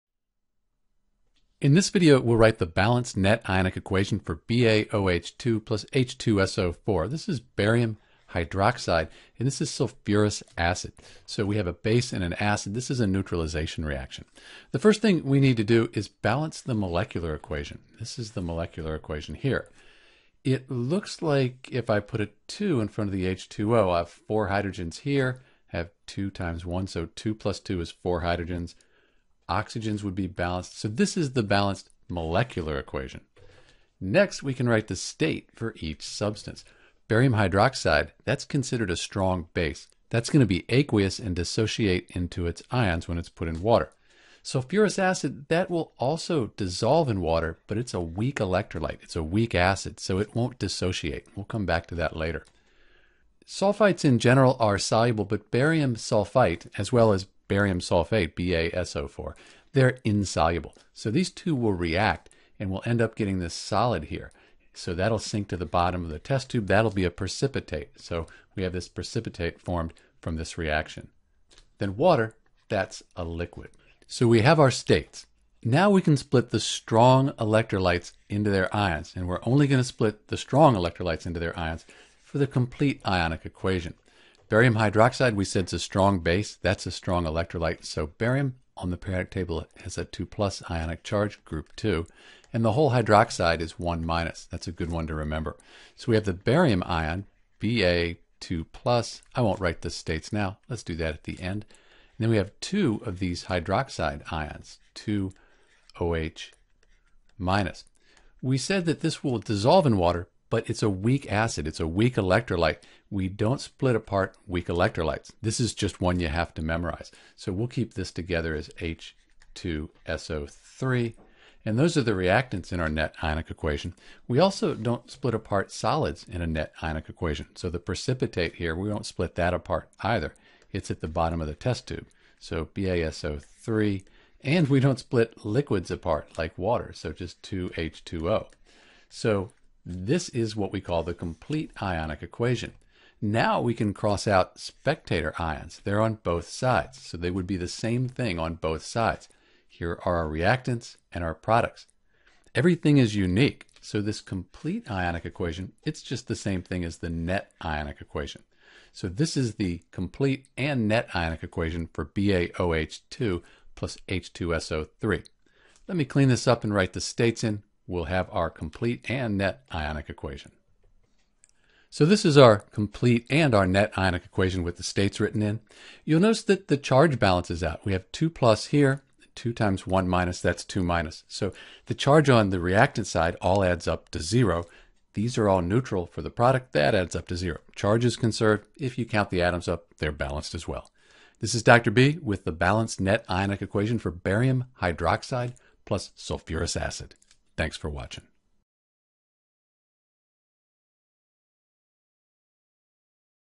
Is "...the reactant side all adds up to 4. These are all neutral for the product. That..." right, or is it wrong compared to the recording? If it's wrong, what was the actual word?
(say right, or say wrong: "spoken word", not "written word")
wrong: "0", not "4".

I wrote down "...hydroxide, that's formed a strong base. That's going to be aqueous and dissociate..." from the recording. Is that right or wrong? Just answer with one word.
wrong.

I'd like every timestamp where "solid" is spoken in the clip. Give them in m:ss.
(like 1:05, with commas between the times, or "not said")
1:03, 2:05.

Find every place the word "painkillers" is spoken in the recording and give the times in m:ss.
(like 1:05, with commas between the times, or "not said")
not said.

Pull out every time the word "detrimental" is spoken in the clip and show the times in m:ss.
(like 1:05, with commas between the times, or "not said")
not said.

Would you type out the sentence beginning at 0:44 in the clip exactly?
Sulfurous acid, that will also dissolve in water, but it's a weak electrolyte.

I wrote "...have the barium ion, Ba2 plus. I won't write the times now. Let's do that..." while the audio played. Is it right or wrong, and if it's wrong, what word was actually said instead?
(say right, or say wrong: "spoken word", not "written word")
wrong: "states", not "times".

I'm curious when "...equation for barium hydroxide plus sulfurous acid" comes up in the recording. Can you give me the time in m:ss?
3:13.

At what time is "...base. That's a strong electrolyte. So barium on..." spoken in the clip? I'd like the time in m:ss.
1:26.